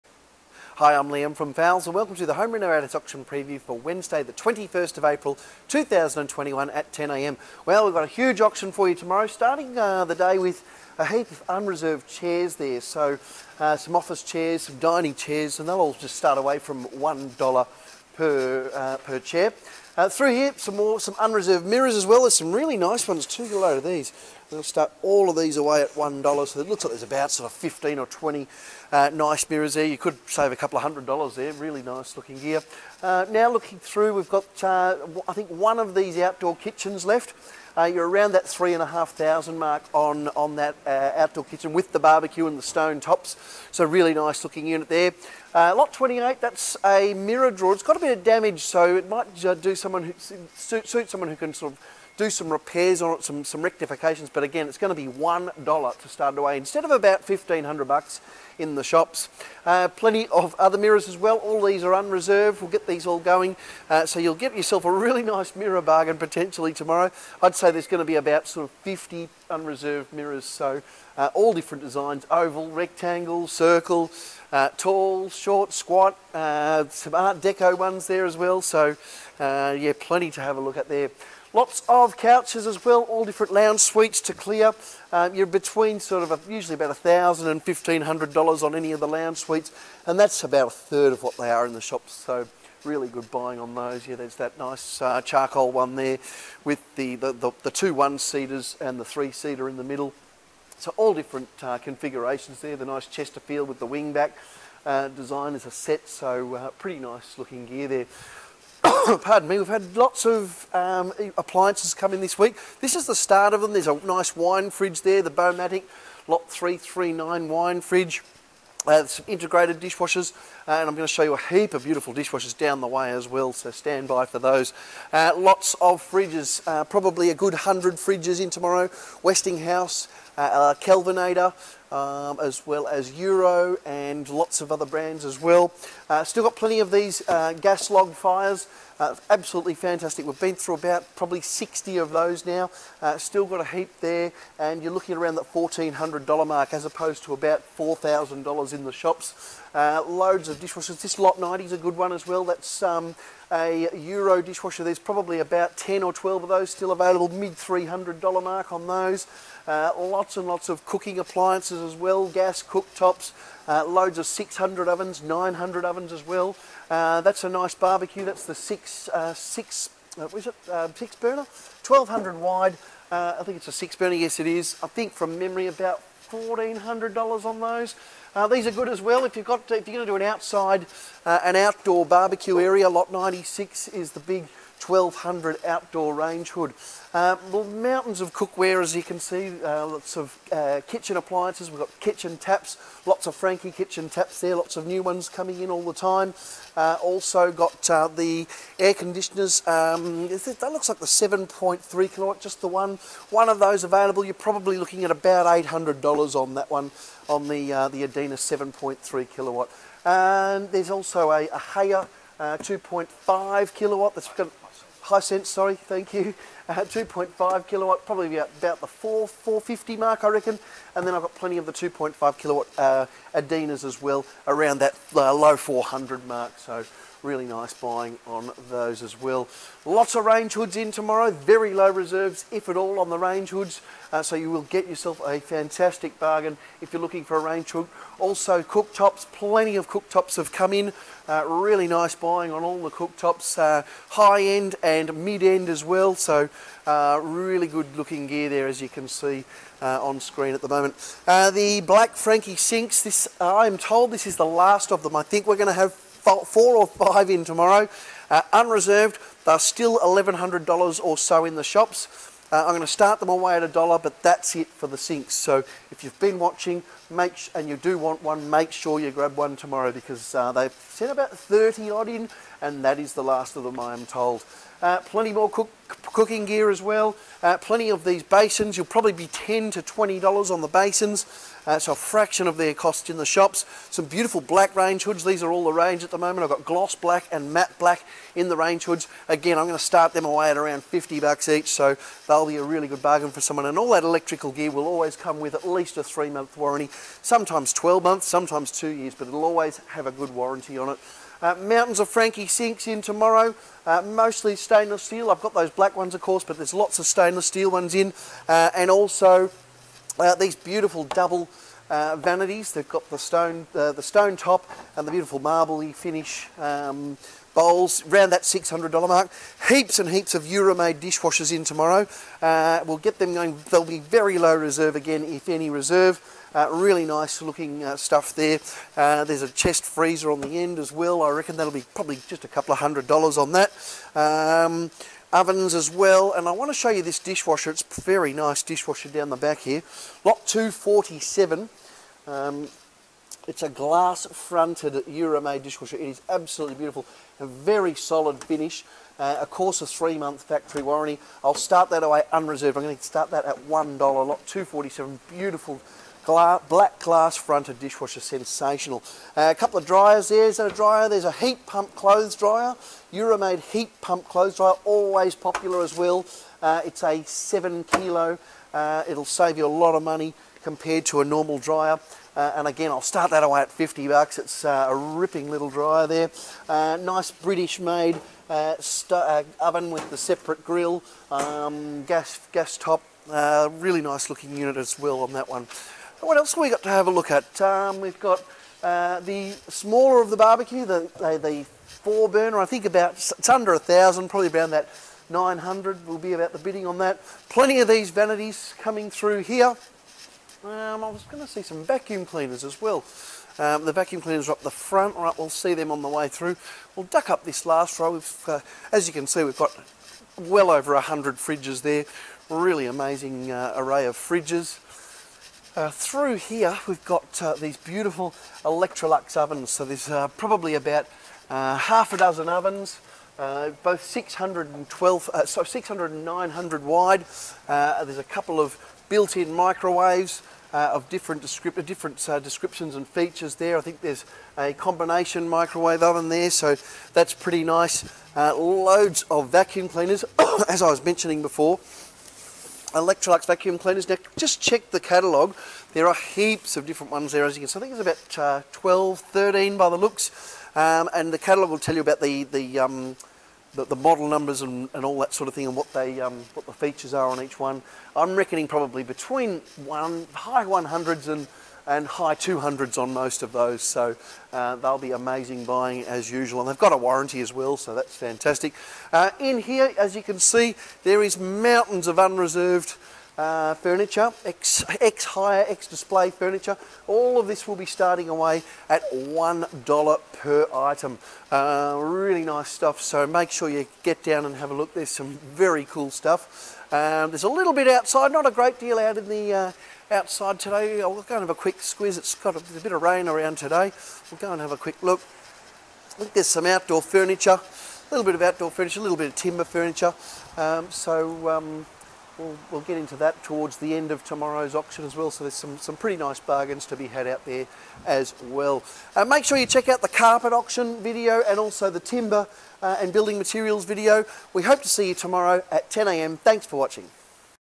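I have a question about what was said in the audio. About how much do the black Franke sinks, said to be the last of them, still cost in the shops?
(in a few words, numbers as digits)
$1,100.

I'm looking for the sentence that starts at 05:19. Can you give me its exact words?
Heaps and heaps of Euromaid dishwashers in tomorrow.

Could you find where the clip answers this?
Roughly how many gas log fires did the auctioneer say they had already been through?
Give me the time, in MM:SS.
02:21.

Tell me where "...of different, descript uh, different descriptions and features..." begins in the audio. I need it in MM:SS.
07:10.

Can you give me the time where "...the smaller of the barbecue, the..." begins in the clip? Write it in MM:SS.
06:28.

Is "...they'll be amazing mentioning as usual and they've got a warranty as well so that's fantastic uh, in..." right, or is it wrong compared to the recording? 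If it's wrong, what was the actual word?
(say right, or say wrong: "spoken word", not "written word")
wrong: "buying", not "mentioning".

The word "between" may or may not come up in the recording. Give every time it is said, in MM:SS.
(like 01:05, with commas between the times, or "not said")
01:25, 07:39.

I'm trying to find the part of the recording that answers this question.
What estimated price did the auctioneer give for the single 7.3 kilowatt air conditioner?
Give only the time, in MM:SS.
03:25.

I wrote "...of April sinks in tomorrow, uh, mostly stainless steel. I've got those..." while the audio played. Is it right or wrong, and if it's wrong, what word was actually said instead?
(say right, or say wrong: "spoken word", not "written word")
wrong: "Franke", not "April".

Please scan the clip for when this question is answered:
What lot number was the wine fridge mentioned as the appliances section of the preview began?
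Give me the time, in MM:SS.
01:56.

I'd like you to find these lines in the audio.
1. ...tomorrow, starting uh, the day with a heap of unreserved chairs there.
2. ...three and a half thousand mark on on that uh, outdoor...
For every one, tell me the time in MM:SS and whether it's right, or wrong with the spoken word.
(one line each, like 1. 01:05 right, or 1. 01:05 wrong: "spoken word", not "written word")
1. 00:08 right
2. 00:38 right.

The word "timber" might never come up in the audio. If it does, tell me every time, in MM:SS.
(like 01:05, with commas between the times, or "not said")
08:19, 08:31.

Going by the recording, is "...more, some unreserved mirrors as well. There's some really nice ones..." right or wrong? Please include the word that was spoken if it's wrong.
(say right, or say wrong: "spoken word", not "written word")
right.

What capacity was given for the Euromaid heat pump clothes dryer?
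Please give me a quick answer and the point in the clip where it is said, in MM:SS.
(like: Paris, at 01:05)
7 kilo, at 06:07.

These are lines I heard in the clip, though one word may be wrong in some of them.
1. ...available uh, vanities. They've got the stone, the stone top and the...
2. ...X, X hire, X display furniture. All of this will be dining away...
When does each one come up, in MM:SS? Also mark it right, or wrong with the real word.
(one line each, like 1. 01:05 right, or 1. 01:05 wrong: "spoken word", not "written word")
1. 05:11 wrong: "double", not "available"
2. 07:54 wrong: "starting", not "dining".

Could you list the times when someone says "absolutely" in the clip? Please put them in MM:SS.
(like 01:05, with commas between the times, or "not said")
02:19, 05:46.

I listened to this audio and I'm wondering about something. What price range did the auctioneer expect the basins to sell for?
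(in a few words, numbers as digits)
10 to $20.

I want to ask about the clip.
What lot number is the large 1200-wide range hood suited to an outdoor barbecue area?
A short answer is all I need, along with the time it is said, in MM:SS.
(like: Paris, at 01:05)
96, at 03:02.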